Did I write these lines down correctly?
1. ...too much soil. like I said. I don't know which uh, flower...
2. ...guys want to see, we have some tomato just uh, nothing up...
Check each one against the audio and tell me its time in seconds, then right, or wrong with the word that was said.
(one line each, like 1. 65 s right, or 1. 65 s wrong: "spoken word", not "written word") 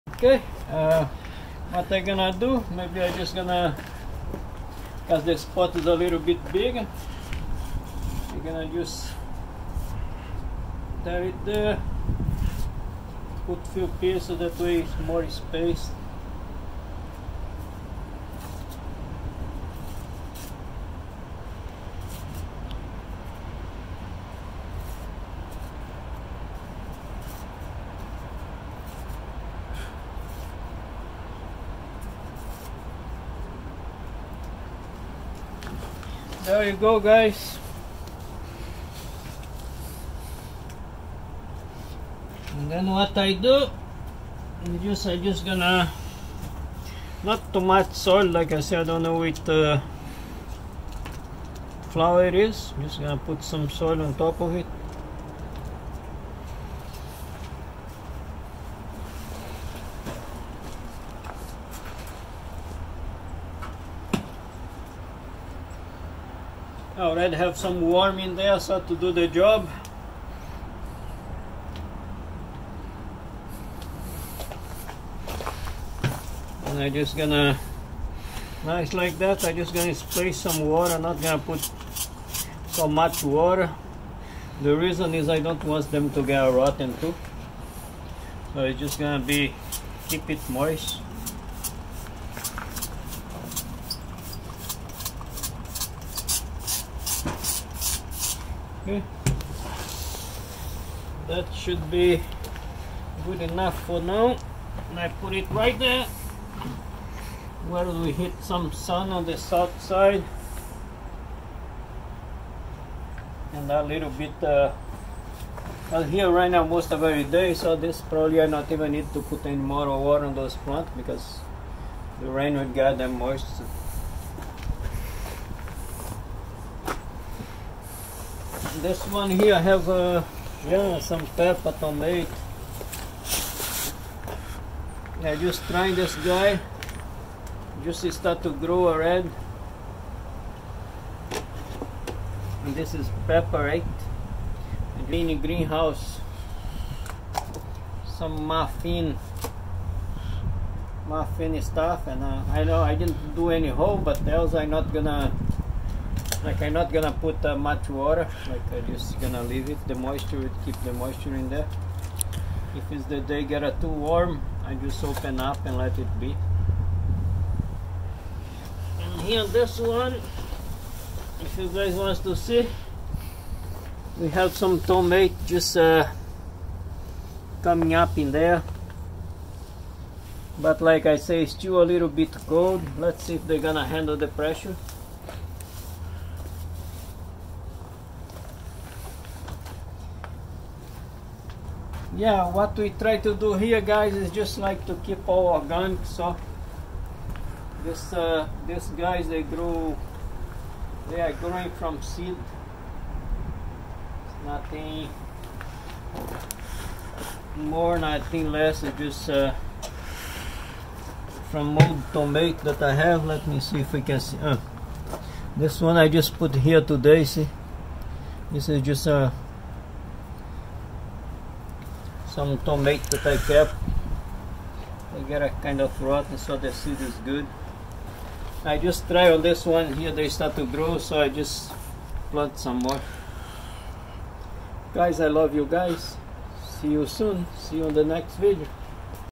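1. 47 s right
2. 171 s wrong: "coming", not "nothing".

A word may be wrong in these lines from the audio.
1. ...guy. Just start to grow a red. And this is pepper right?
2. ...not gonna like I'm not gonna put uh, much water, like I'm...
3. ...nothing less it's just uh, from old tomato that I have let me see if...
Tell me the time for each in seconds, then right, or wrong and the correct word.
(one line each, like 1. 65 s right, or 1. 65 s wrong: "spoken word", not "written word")
1. 136 s right
2. 154 s right
3. 207 s right.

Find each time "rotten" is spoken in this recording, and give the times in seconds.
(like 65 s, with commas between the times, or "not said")
86 s, 226 s.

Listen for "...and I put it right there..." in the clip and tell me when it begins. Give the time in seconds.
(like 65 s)
104 s.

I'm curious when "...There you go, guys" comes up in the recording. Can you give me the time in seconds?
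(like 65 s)
36 s.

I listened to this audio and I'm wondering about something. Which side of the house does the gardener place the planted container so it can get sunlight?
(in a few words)
South side.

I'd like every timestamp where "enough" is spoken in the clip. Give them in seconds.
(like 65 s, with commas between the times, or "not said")
103 s.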